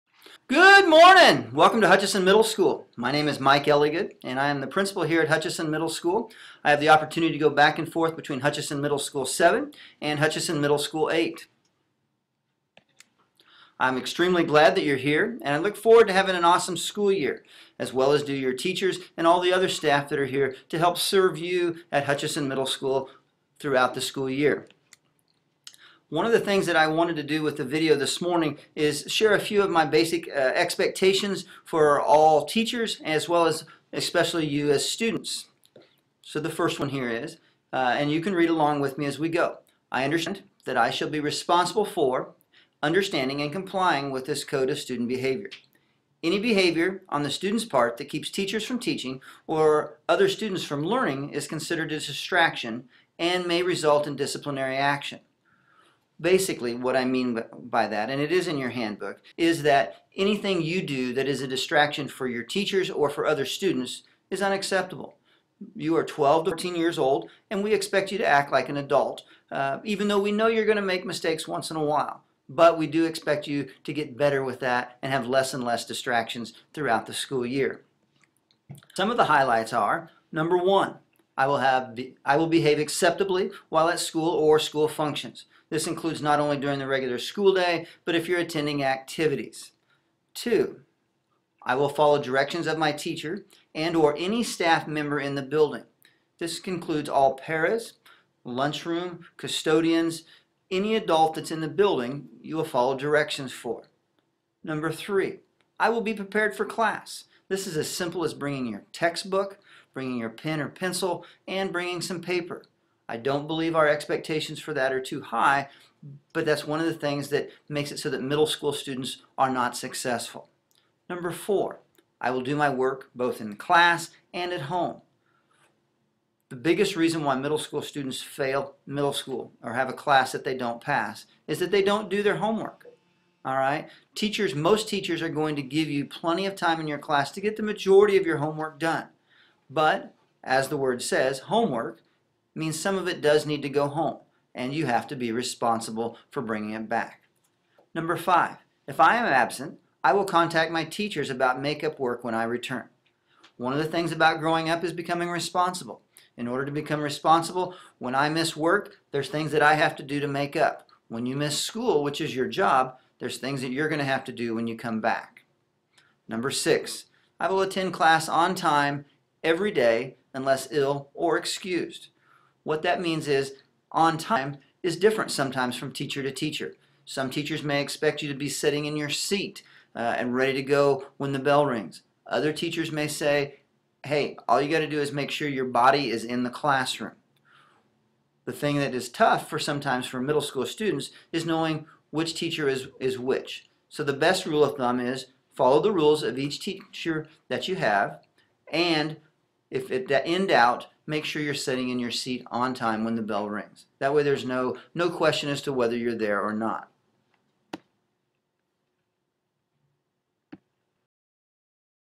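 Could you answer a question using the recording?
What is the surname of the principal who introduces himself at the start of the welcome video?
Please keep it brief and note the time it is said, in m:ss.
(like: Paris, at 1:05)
Elligood, at 0:03.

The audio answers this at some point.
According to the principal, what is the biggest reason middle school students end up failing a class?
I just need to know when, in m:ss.
2:11.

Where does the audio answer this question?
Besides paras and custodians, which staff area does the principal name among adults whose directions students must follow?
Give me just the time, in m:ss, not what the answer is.
1:38.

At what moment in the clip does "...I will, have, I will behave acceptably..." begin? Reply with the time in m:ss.
1:21.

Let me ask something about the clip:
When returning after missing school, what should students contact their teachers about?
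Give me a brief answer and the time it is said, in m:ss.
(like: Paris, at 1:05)
Makeup work, at 2:31.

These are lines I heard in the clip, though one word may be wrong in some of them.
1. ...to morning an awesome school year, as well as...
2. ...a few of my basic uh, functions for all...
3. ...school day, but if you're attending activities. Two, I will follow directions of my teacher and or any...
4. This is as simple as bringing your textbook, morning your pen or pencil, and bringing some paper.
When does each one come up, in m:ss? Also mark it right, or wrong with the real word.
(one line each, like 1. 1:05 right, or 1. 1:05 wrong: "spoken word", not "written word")
1. 0:16 wrong: "having", not "morning"
2. 0:29 wrong: "expectations", not "functions"
3. 1:27 right
4. 1:47 wrong: "bringing", not "morning".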